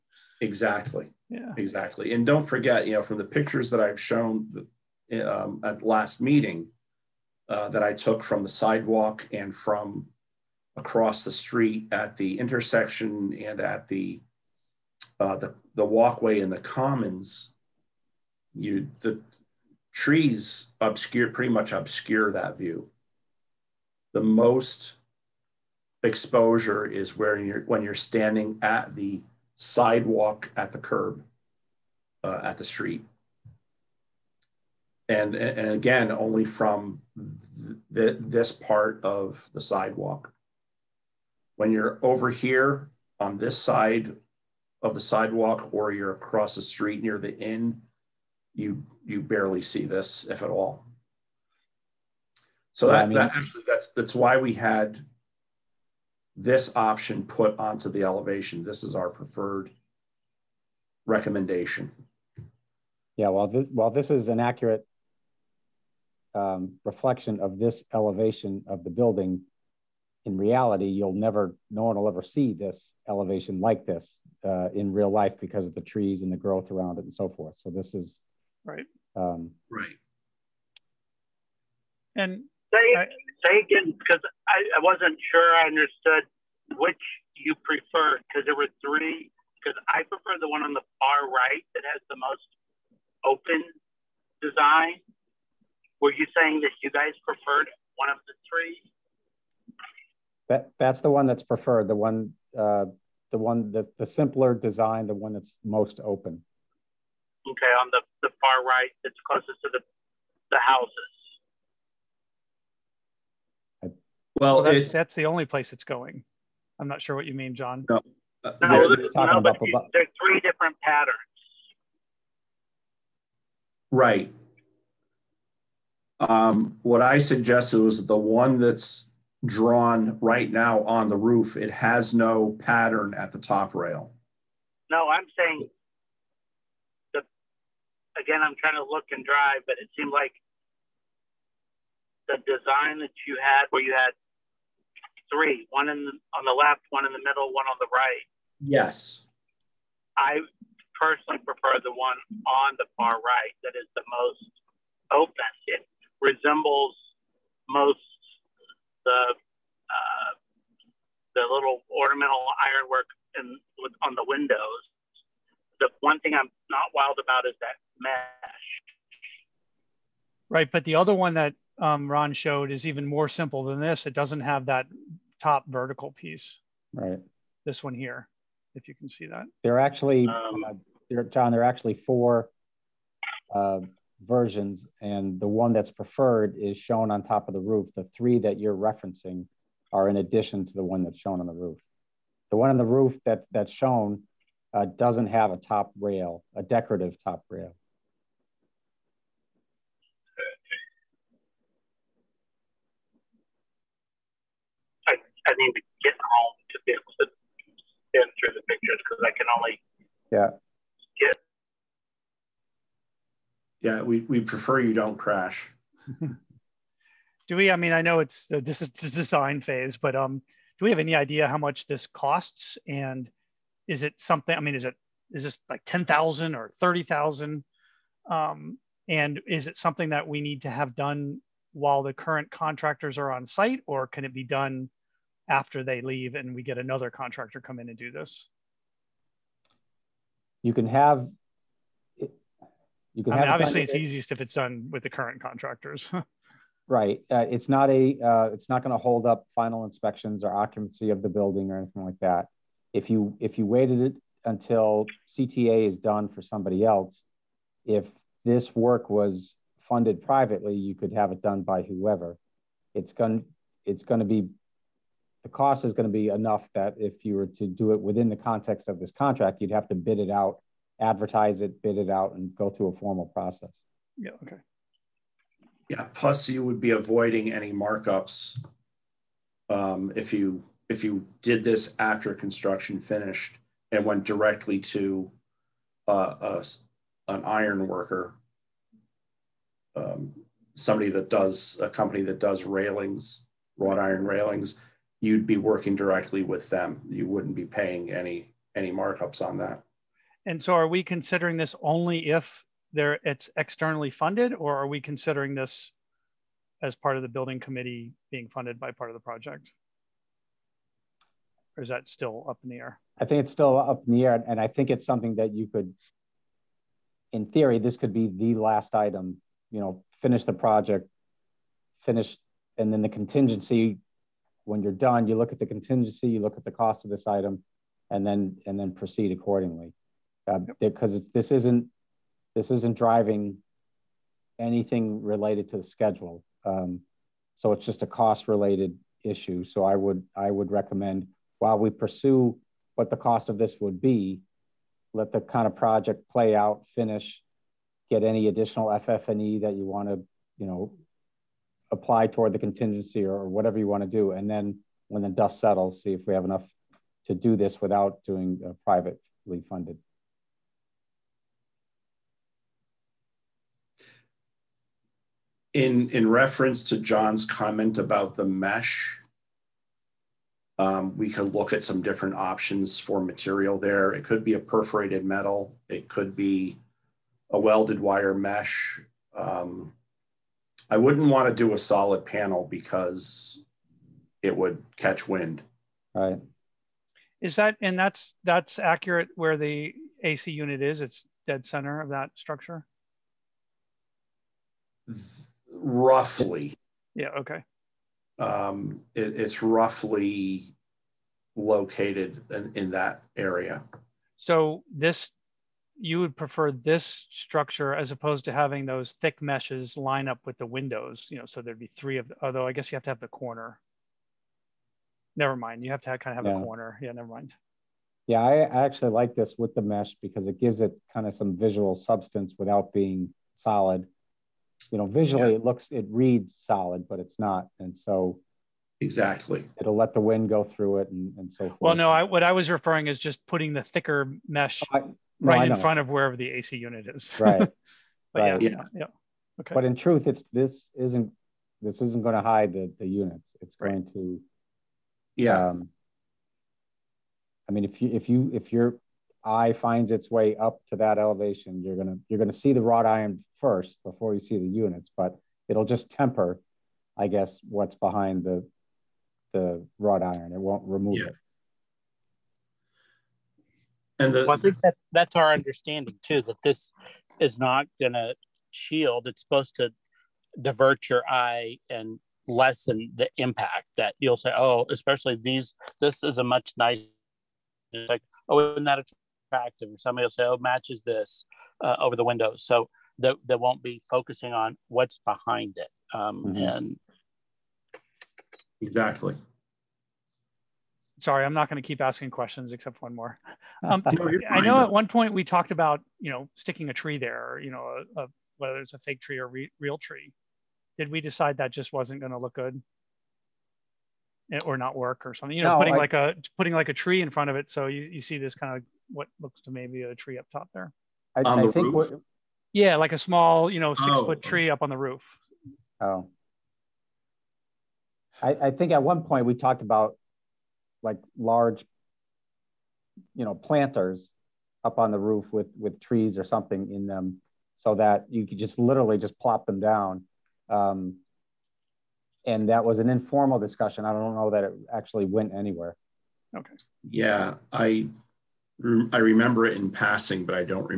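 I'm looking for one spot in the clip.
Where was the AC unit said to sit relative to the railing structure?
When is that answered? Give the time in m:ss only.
6:31.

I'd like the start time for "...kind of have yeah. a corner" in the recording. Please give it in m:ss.
6:56.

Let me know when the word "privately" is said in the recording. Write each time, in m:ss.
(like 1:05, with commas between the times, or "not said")
4:20, 5:58.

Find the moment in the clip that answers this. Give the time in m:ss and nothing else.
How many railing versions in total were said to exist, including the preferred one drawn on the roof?
3:01.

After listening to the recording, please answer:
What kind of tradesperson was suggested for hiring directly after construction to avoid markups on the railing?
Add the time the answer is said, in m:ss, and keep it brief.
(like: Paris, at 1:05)
iron worker, at 4:47.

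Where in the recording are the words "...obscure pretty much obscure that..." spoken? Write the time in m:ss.
0:20.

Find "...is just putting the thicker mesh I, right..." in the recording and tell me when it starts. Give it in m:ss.
7:13.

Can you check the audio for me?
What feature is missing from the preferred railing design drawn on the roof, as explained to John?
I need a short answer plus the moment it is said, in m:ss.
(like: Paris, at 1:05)
decorative top rail, at 3:16.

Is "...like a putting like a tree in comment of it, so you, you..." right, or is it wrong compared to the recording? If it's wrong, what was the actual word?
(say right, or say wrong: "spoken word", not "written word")
wrong: "front", not "comment".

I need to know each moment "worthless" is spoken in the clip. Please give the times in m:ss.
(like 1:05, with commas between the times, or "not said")
not said.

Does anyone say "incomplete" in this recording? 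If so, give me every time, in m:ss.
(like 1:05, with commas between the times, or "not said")
not said.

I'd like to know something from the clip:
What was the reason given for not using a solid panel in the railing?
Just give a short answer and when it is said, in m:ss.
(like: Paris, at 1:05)
it would catch wind, at 6:24.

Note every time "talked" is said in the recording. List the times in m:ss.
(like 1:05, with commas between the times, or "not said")
8:15, 8:39.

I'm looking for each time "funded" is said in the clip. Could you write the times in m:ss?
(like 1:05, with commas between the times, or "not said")
4:19, 5:04, 5:08, 5:59.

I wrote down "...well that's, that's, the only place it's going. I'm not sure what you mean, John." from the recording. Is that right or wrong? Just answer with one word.
right.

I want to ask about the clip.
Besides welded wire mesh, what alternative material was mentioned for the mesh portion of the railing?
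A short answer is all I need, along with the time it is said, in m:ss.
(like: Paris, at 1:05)
perforated metal, at 6:14.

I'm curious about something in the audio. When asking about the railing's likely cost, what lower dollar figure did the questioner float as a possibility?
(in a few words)
$10,000.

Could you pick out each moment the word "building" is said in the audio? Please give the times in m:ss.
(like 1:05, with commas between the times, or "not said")
1:08, 4:11, 5:07.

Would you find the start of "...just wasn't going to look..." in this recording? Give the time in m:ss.
8:21.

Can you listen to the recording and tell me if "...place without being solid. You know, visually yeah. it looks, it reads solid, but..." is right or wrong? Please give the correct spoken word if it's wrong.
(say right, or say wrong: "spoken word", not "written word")
wrong: "substance", not "place".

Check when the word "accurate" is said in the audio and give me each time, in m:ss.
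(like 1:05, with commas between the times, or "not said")
1:04, 6:28.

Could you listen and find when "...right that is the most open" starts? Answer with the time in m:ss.
2:33.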